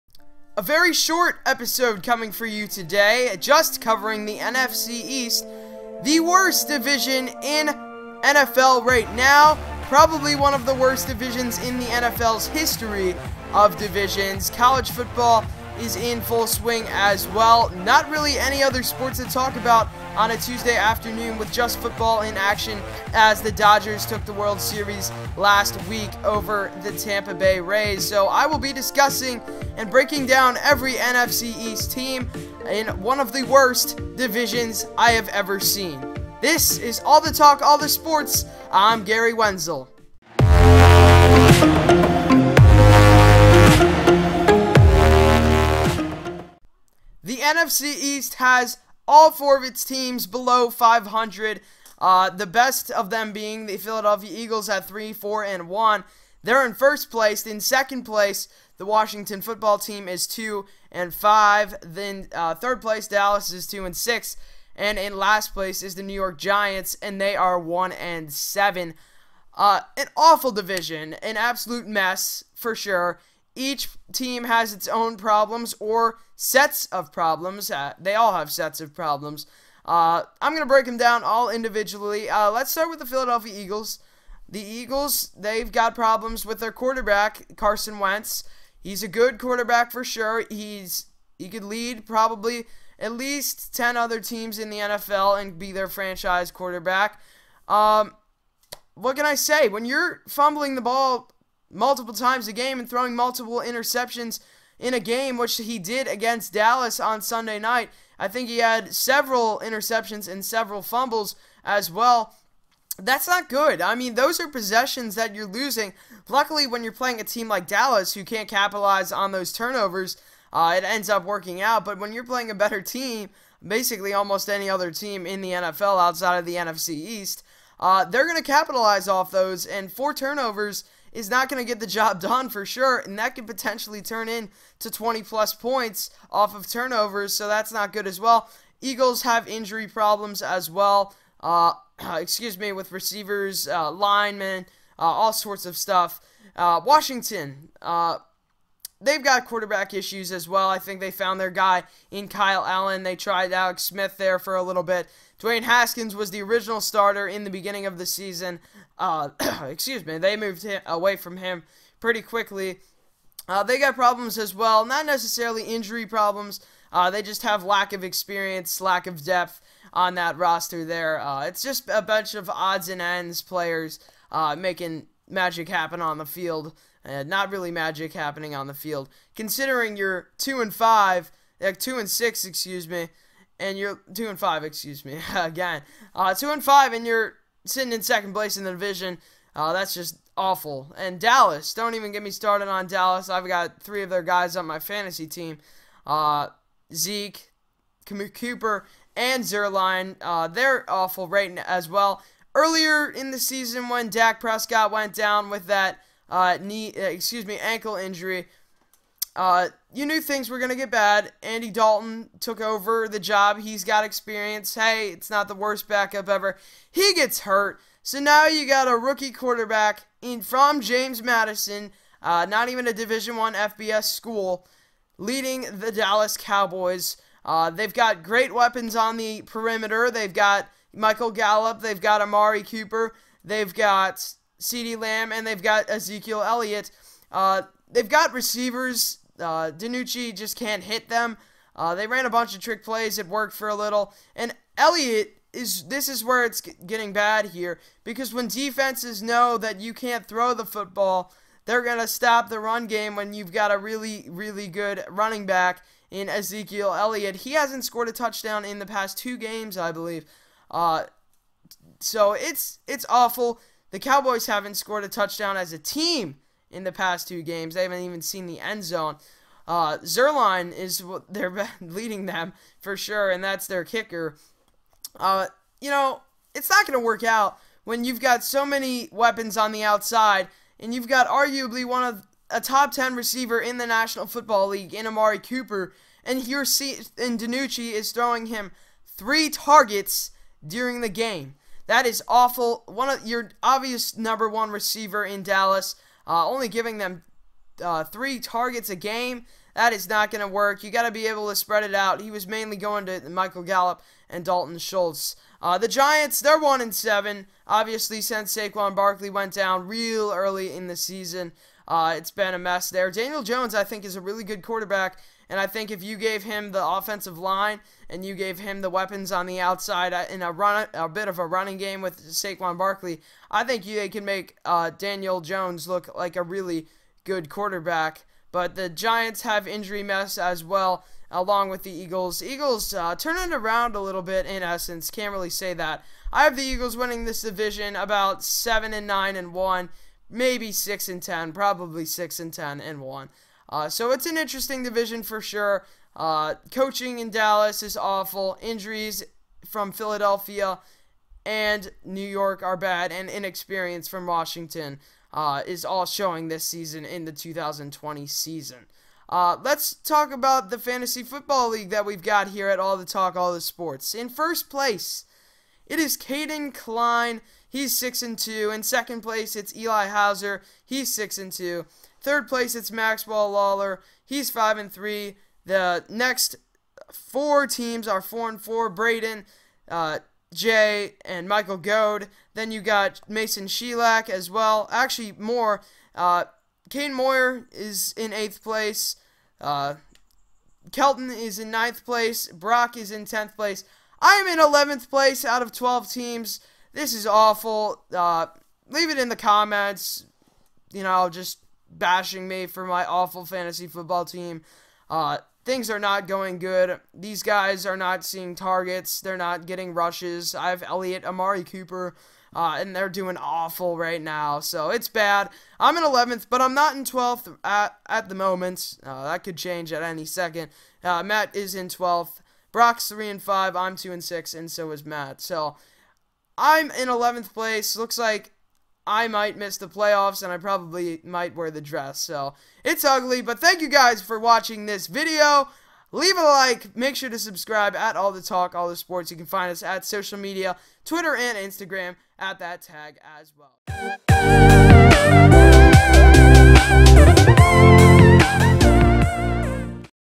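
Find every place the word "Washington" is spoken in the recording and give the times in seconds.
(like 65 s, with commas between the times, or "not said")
58 s, 146 s, 354 s.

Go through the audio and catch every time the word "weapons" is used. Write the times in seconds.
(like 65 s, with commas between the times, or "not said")
228 s, 279 s, 318 s.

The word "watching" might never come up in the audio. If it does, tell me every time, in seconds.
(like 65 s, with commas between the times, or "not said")
434 s.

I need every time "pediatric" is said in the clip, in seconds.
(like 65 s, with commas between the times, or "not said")
not said.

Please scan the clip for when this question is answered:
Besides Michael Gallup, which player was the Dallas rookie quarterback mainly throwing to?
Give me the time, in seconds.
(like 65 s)
304 s.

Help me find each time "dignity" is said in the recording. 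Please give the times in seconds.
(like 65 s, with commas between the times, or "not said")
not said.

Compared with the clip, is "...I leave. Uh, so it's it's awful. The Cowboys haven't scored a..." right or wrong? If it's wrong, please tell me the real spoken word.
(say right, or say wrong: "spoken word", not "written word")
wrong: "believe", not "leave".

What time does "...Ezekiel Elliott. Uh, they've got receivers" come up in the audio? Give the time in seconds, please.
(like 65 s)
235 s.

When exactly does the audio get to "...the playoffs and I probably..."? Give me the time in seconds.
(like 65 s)
429 s.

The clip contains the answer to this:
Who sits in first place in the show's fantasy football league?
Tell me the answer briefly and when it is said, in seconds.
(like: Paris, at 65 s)
Caden Klein, at 366 s.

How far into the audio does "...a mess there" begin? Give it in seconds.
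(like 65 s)
312 s.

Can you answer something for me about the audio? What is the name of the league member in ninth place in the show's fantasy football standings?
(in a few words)
Kelton.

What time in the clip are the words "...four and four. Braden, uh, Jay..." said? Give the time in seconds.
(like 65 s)
378 s.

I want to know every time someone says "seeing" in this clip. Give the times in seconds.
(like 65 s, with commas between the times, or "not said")
408 s.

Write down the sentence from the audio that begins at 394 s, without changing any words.
I am in 11th place out of 12 teams.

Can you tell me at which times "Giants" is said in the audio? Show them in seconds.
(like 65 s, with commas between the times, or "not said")
66 s, 305 s, 328 s.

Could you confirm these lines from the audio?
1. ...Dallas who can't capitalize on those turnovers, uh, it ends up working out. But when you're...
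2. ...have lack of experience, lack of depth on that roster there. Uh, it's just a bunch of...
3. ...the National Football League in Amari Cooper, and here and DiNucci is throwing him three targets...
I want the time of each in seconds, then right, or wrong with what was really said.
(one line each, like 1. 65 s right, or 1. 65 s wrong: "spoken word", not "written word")
1. 117 s right
2. 167 s right
3. 283 s right.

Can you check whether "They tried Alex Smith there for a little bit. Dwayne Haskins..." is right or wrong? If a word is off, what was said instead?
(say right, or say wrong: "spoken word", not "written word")
right.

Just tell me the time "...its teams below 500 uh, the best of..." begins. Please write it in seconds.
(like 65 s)
49 s.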